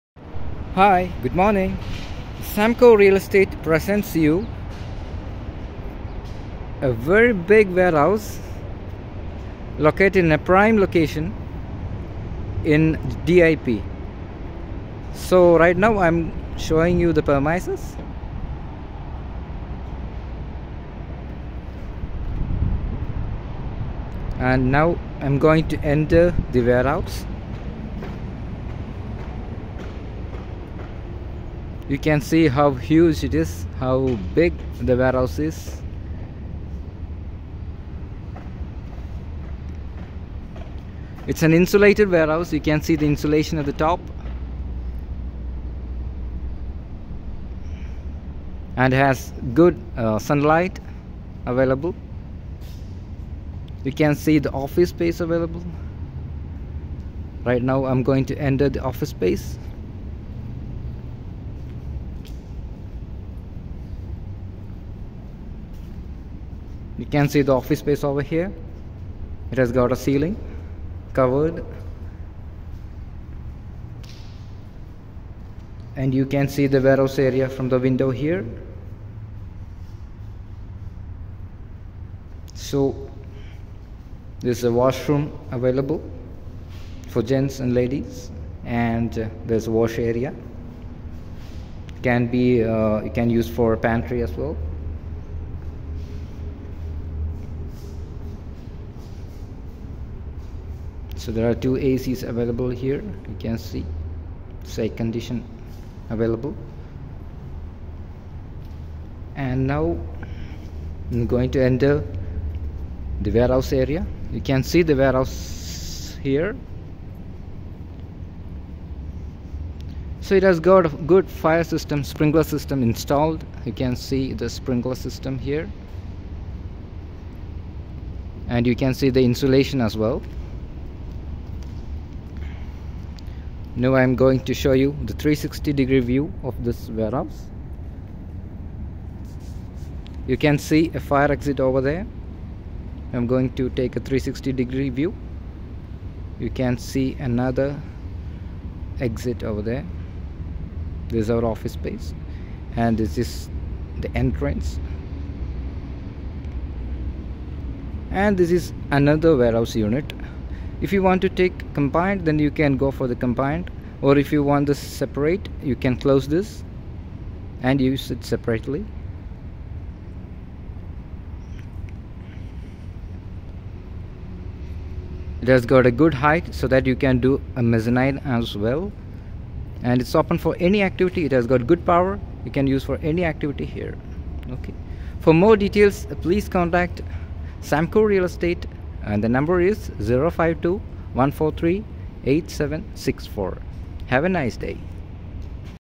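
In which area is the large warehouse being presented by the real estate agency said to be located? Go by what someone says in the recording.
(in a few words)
DIP.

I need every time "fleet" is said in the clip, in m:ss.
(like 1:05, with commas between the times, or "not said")
not said.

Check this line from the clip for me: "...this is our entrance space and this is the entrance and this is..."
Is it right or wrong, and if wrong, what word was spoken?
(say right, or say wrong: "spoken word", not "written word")
wrong: "office", not "entrance".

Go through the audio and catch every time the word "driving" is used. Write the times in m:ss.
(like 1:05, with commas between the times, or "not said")
not said.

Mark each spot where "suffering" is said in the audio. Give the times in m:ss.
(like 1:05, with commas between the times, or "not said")
not said.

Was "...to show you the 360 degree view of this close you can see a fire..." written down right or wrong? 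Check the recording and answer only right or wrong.
wrong.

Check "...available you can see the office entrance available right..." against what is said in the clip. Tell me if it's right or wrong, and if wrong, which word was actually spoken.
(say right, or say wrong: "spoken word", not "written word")
wrong: "space", not "entrance".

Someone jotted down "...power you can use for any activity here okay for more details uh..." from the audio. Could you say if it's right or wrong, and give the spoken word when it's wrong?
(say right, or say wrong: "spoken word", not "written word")
right.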